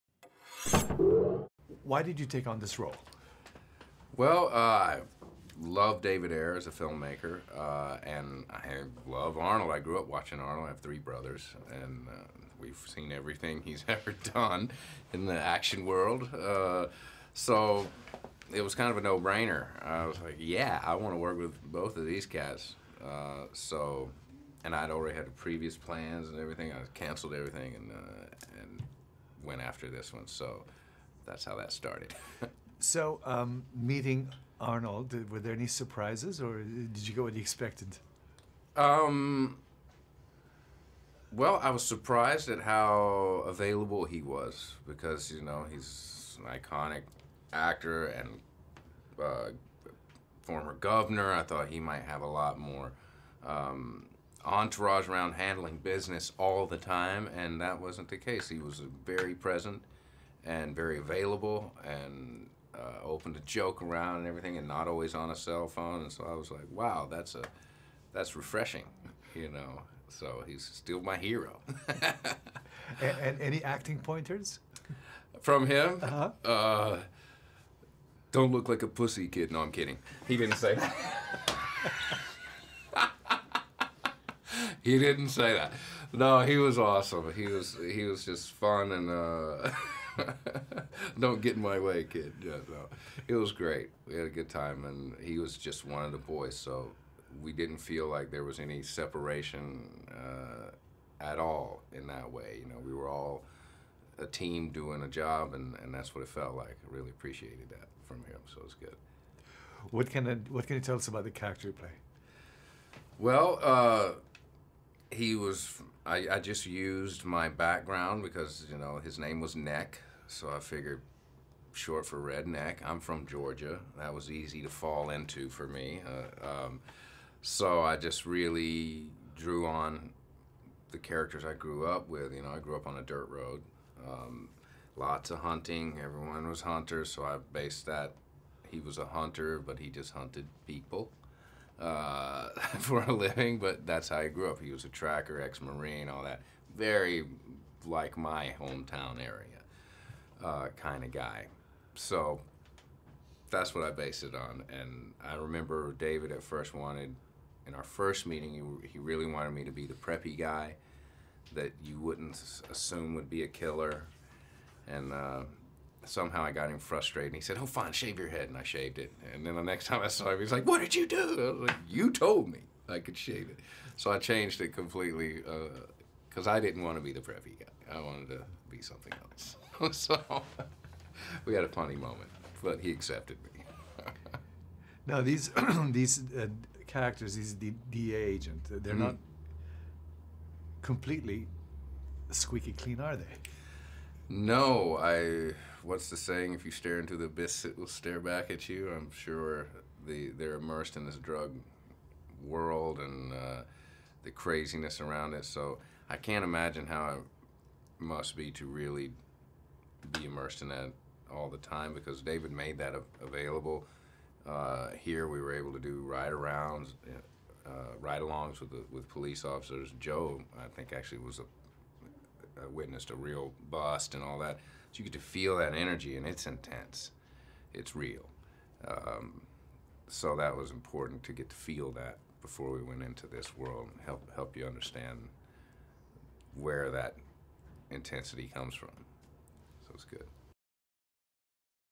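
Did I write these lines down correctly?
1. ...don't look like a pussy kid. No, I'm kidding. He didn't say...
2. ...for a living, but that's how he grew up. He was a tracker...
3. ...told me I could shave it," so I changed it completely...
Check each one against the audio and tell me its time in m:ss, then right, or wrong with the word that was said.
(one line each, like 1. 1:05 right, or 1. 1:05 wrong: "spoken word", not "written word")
1. 1:18 right
2. 2:22 right
3. 2:52 right.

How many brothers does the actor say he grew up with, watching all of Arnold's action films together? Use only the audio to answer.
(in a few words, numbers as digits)
3.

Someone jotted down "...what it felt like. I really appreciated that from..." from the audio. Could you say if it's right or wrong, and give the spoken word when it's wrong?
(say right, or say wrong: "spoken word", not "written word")
right.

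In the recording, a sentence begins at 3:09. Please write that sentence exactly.
not completely squeaky clean, are they?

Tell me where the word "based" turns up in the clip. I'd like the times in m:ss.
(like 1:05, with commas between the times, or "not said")
2:17, 2:33.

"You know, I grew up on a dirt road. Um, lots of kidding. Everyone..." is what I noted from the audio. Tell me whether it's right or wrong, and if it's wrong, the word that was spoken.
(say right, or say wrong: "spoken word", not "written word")
wrong: "hunting", not "kidding".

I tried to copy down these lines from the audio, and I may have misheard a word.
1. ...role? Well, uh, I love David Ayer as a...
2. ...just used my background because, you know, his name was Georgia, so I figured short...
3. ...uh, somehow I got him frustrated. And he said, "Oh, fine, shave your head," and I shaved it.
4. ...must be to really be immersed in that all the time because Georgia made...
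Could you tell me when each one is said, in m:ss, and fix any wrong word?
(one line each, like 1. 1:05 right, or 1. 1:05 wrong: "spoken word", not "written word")
1. 0:02 right
2. 1:56 wrong: "Neck", not "Georgia"
3. 2:45 right
4. 3:28 wrong: "David", not "Georgia".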